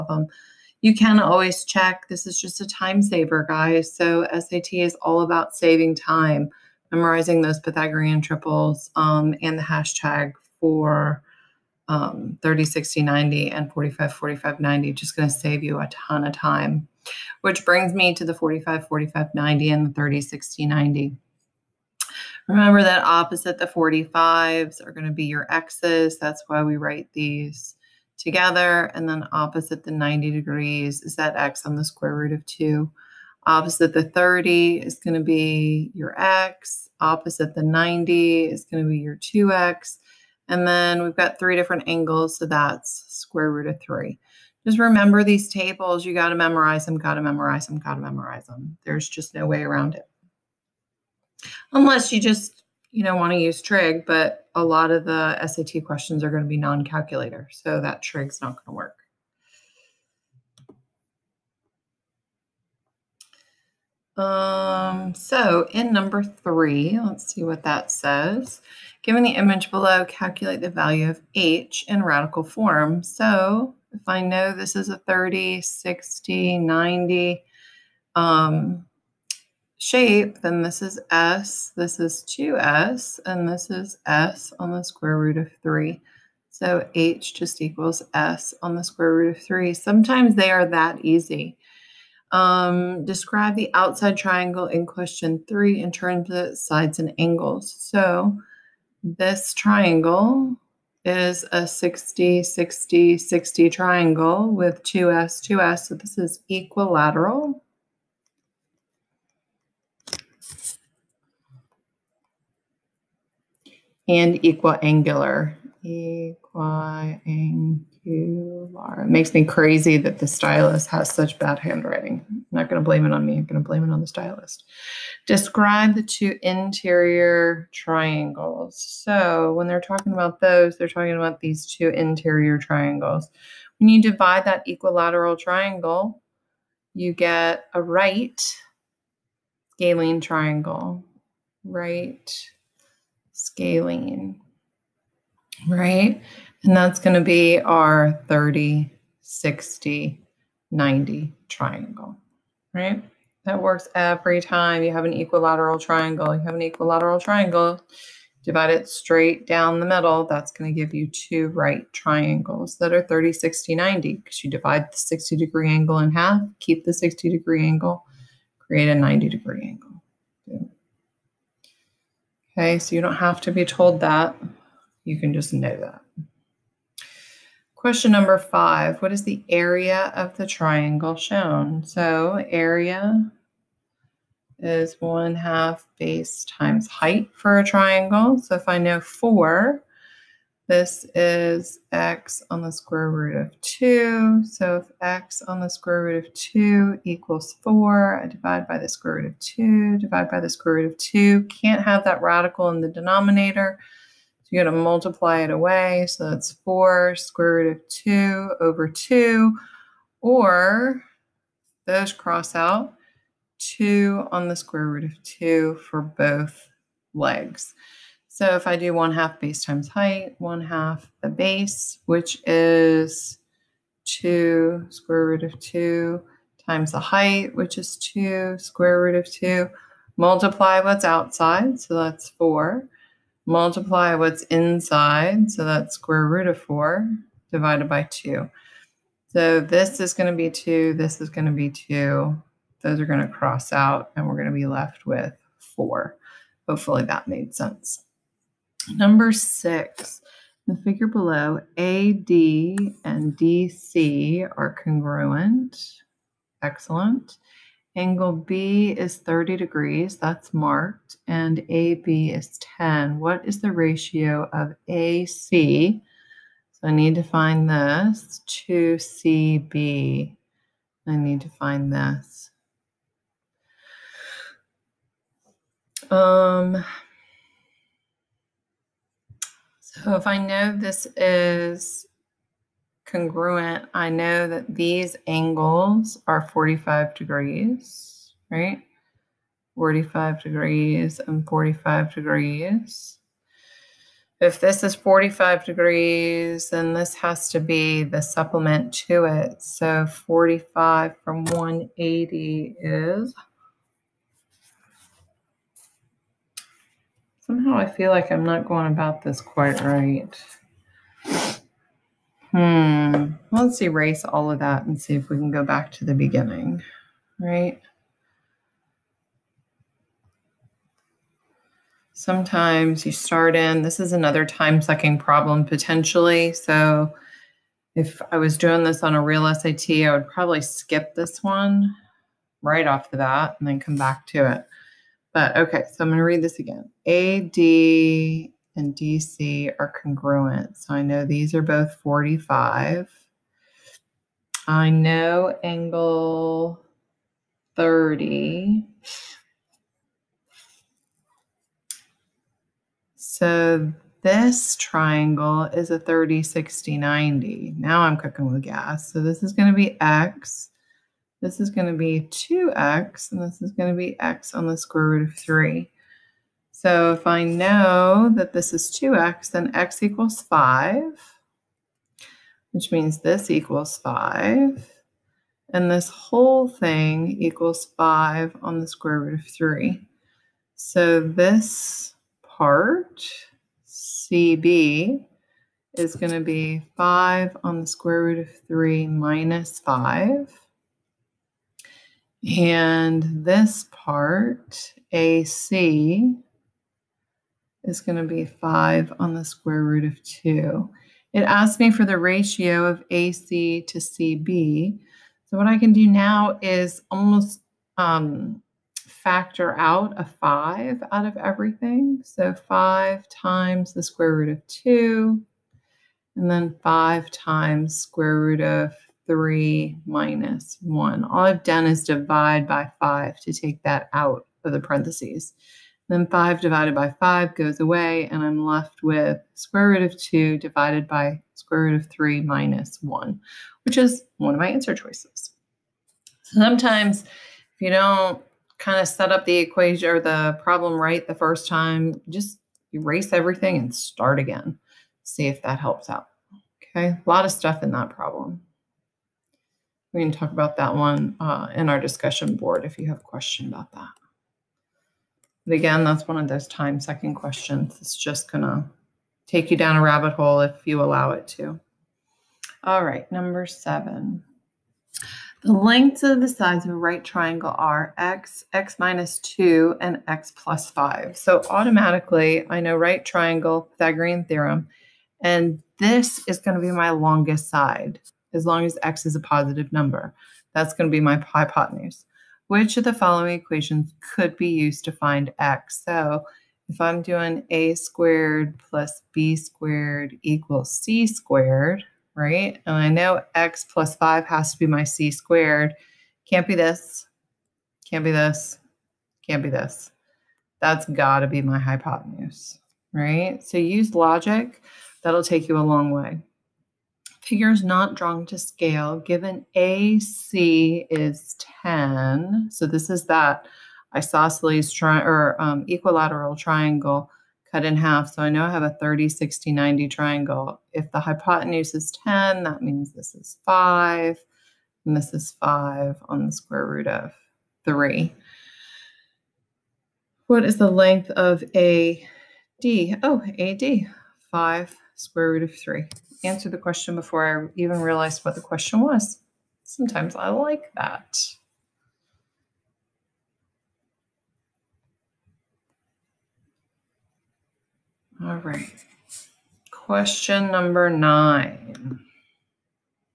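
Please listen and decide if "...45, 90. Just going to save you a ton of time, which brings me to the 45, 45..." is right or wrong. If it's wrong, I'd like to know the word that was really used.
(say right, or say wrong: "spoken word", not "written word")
right.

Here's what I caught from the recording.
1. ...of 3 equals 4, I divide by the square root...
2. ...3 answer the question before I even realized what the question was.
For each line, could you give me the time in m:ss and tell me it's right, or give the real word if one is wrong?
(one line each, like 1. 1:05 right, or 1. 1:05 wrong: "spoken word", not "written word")
1. 3:16 wrong: "2", not "3"
2. 8:55 right.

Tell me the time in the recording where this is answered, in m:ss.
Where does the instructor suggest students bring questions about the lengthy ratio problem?
7:31.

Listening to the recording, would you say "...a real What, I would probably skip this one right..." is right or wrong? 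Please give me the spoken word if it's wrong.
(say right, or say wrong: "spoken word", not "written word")
wrong: "SAT", not "What".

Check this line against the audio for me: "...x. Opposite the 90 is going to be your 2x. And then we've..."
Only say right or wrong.
right.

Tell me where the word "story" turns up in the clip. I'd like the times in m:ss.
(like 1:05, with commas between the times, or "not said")
not said.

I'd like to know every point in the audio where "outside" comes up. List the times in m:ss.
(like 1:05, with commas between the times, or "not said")
1:33, 3:51.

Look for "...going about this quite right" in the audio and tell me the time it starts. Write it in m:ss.
5:08.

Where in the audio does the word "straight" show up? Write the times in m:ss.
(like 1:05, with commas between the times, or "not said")
2:38.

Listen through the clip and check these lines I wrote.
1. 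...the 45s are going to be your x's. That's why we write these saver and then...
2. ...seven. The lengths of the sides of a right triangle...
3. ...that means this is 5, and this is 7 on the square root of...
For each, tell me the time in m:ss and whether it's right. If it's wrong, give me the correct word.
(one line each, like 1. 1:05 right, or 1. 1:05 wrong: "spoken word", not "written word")
1. 0:23 wrong: "together", not "saver"
2. 7:43 right
3. 8:42 wrong: "5", not "7".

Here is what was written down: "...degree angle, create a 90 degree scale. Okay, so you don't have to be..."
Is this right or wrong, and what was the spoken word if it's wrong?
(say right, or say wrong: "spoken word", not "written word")
wrong: "angle", not "scale".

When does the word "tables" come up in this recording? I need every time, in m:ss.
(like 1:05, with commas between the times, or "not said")
0:45.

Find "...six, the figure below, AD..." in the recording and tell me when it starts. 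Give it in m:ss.
4:09.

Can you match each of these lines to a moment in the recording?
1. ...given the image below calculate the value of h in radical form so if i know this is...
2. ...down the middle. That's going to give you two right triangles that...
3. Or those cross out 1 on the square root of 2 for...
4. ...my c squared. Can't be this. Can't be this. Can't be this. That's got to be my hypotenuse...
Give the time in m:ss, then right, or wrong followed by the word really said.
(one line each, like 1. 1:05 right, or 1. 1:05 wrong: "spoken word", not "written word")
1. 1:09 right
2. 2:39 right
3. 3:30 wrong: "2", not "1"
4. 8:14 right.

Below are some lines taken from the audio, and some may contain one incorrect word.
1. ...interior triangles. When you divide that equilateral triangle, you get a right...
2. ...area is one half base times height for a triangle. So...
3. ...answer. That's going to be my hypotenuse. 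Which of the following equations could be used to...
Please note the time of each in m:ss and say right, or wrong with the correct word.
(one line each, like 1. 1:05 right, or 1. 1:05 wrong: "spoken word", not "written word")
1. 2:11 right
2. 3:02 right
3. 7:59 wrong: "number", not "answer".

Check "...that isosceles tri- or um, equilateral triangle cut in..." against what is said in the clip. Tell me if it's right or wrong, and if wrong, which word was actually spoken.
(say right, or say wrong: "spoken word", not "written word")
right.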